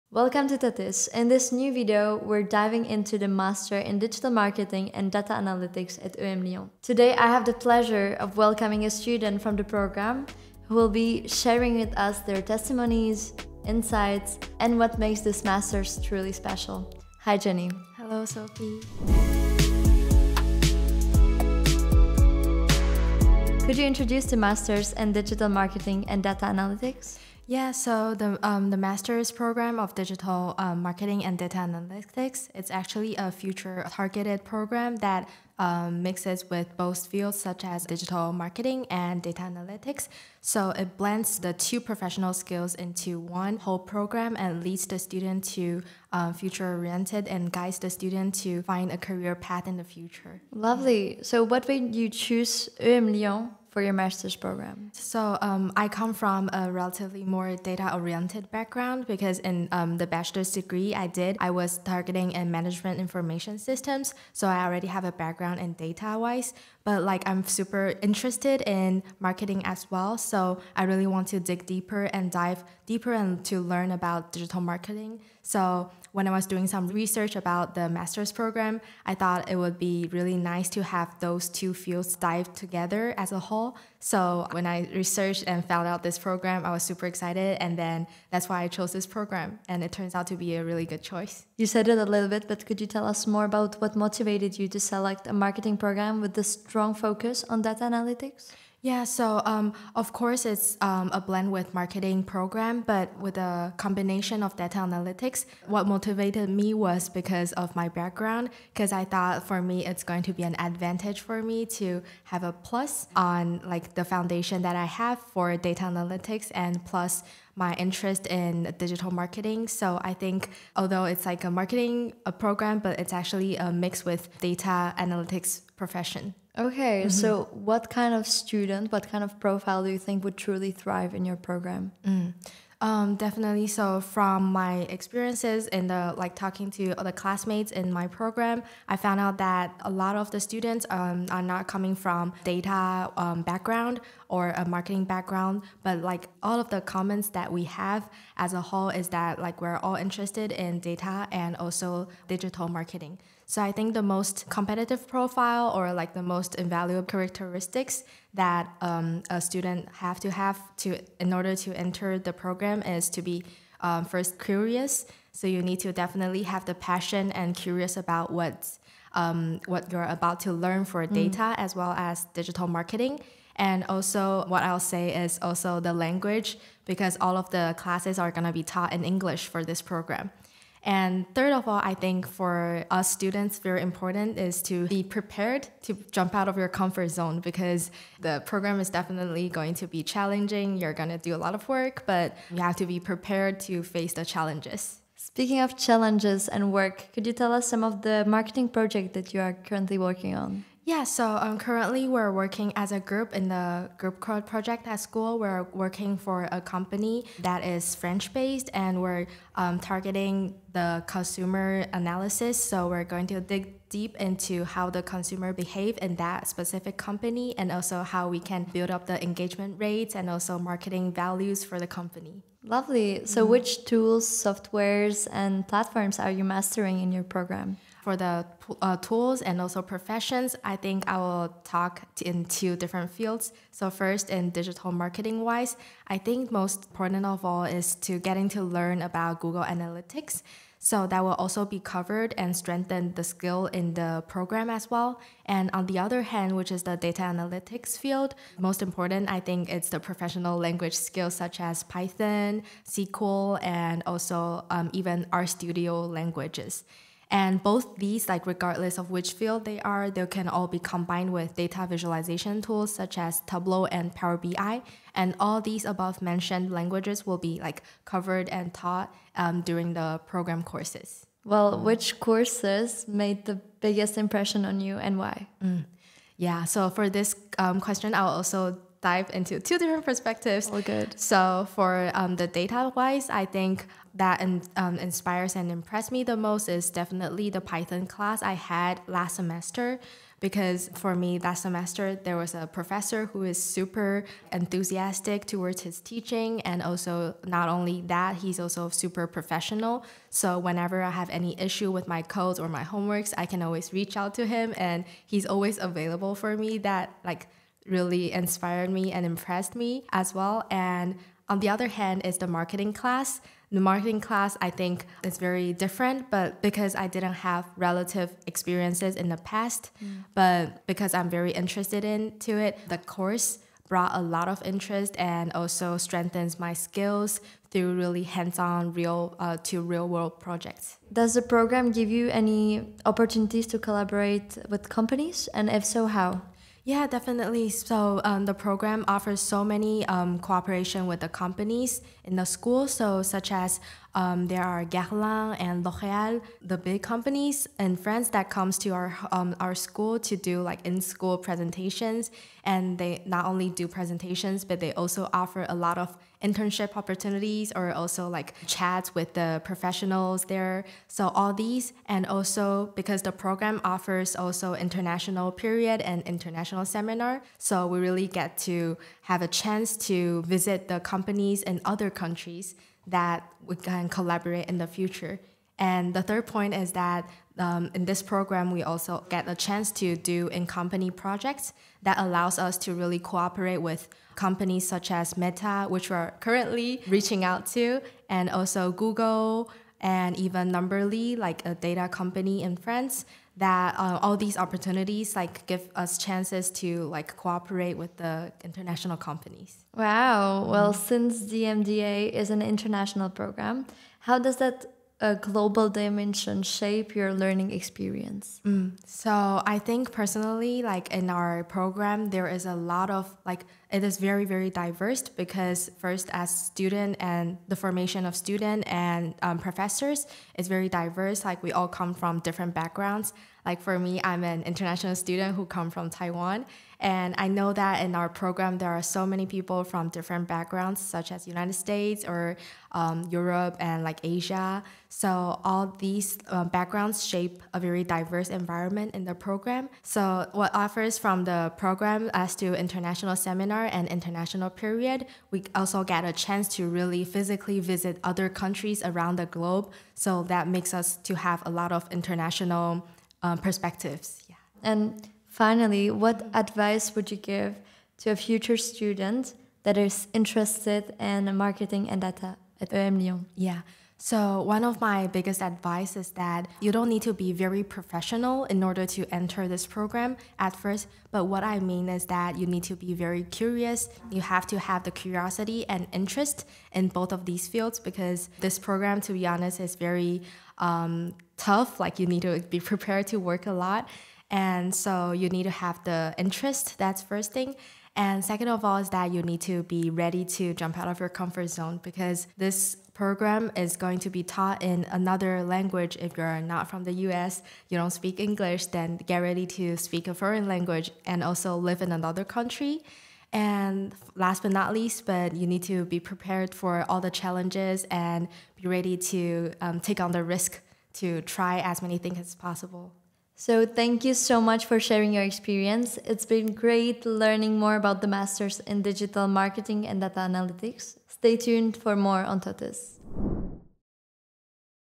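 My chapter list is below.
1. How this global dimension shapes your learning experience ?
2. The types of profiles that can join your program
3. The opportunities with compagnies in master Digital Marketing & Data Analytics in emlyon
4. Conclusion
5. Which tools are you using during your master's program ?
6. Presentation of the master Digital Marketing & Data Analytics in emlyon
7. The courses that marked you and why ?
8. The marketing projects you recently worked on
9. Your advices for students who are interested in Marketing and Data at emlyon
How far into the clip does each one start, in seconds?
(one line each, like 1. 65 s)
1. 400 s
2. 126 s
3. 331 s
4. 514 s
5. 222 s
6. 23 s
7. 272 s
8. 195 s
9. 455 s.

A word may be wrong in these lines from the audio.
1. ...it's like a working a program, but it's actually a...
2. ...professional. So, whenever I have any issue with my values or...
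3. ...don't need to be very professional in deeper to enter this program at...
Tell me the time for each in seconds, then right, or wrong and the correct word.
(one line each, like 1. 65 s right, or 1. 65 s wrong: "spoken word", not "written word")
1. 121 s wrong: "marketing", not "working"
2. 299 s wrong: "codes", not "values"
3. 466 s wrong: "order", not "deeper".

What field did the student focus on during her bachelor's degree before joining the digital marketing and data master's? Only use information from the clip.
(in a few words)
Management information systems.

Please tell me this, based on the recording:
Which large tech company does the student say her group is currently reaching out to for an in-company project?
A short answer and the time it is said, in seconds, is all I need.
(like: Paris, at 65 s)
Meta, at 385 s.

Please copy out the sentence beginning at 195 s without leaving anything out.
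Speaking of challenges and work, could you tell us some of the marketing project that you are currently working on?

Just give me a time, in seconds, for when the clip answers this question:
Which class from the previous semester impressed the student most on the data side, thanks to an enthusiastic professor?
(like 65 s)
287 s.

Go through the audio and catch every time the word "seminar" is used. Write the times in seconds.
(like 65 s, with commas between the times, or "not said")
366 s, 443 s.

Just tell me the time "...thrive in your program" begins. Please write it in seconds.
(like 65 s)
130 s.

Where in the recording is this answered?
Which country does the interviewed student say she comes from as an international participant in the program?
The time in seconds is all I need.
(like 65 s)
426 s.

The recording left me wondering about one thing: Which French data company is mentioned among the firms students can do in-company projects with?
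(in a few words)
Numberly.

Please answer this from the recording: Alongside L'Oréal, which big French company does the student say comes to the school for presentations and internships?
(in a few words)
Guerlain.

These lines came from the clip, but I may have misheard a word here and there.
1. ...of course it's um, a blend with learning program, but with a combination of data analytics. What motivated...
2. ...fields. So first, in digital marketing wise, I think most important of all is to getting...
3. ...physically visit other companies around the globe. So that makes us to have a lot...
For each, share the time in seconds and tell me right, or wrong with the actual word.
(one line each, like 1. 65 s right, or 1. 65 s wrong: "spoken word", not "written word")
1. 99 s wrong: "marketing", not "learning"
2. 233 s right
3. 447 s wrong: "countries", not "companies".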